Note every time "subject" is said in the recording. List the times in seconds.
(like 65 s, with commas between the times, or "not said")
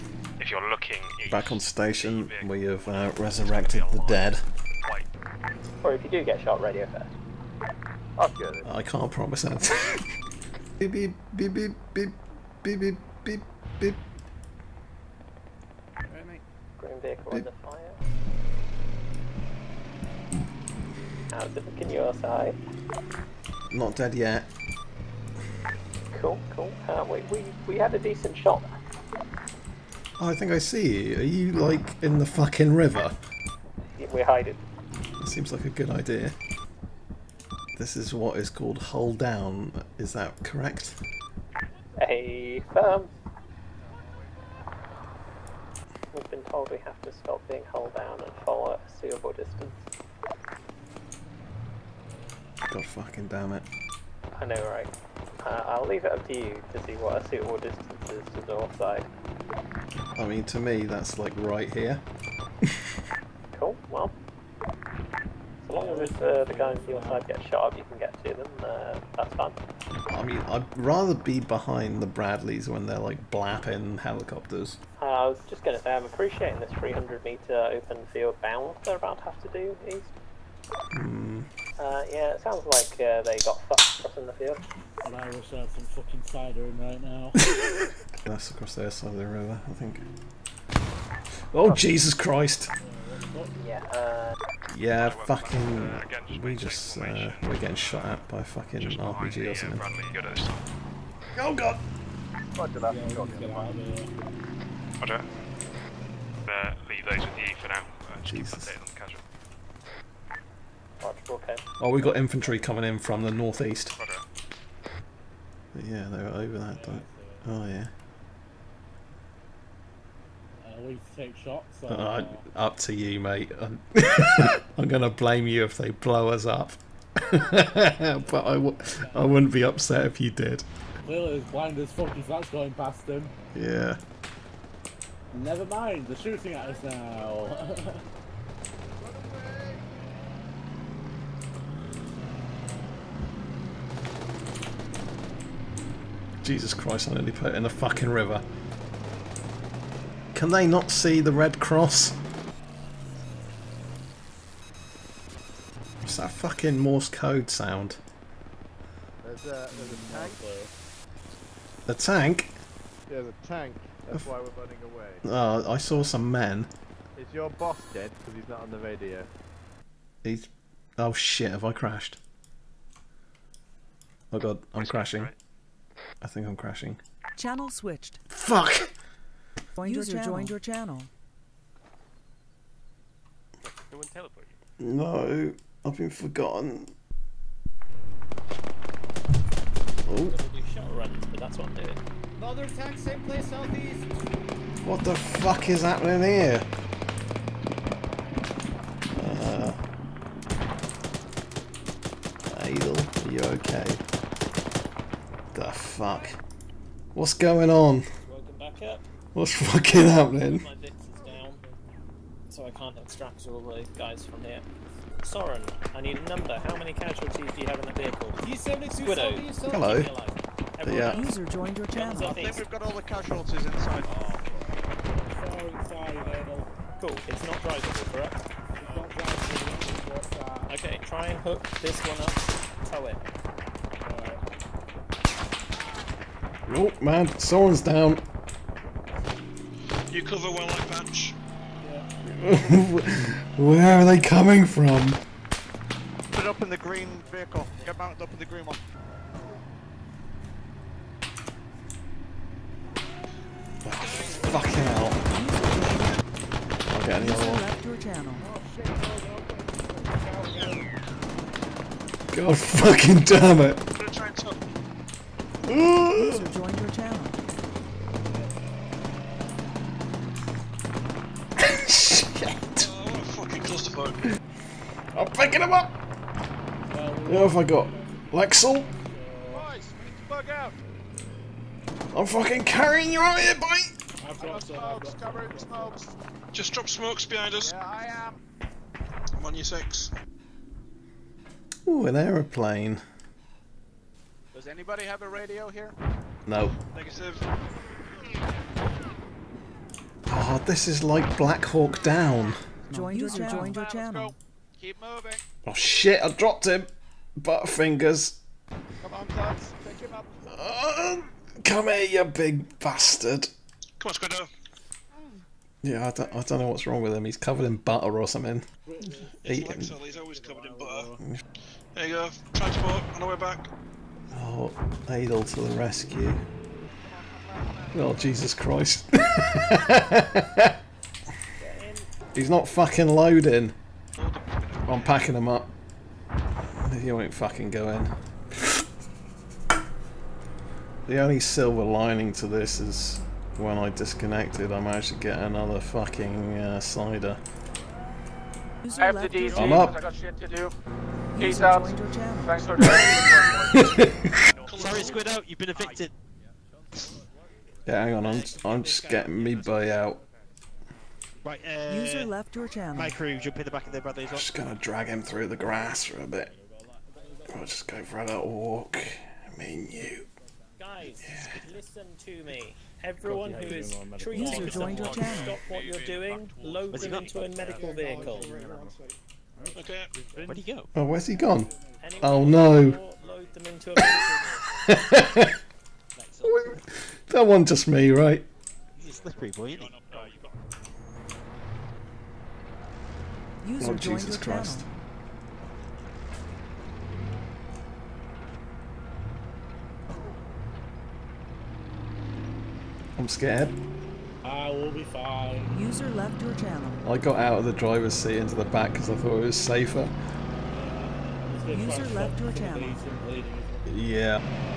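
not said.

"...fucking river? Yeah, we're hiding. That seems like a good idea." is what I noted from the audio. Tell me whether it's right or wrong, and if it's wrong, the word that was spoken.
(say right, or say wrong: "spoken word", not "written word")
right.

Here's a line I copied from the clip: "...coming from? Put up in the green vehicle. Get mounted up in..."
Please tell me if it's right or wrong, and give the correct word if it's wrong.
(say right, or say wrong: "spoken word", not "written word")
right.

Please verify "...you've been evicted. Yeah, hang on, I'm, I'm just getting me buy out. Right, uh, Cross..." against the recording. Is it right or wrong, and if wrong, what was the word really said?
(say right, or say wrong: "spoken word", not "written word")
wrong: "User", not "Cross".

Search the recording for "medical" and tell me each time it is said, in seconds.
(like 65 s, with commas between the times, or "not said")
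377 s.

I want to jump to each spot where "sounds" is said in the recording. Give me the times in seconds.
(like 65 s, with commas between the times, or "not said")
82 s, 157 s.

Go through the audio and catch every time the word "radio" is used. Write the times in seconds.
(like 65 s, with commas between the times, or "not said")
6 s, 168 s, 295 s.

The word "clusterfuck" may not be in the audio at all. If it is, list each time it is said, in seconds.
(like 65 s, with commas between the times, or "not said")
273 s.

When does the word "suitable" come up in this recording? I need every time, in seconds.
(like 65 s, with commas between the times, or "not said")
49 s, 57 s.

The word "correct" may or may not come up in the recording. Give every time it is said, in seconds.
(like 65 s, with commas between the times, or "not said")
40 s, 228 s.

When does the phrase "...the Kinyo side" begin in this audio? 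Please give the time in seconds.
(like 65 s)
21 s.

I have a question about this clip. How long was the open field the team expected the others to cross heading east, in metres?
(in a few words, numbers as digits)
300 metres.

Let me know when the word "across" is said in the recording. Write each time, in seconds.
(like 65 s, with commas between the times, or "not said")
83 s, 88 s.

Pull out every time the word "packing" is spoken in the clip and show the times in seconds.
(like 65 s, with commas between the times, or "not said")
335 s.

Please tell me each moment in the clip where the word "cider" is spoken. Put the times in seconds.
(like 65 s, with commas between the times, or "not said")
86 s, 346 s.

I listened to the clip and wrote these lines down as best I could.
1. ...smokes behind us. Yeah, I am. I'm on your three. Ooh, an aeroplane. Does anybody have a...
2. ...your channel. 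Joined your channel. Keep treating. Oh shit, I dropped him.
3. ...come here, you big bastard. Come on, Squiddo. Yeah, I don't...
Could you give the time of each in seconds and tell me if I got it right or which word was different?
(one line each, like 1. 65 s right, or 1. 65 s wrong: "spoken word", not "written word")
1. 286 s wrong: "six", not "three"
2. 303 s wrong: "moving", not "treating"
3. 311 s right.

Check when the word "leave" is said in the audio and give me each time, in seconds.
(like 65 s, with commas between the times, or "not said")
55 s, 106 s.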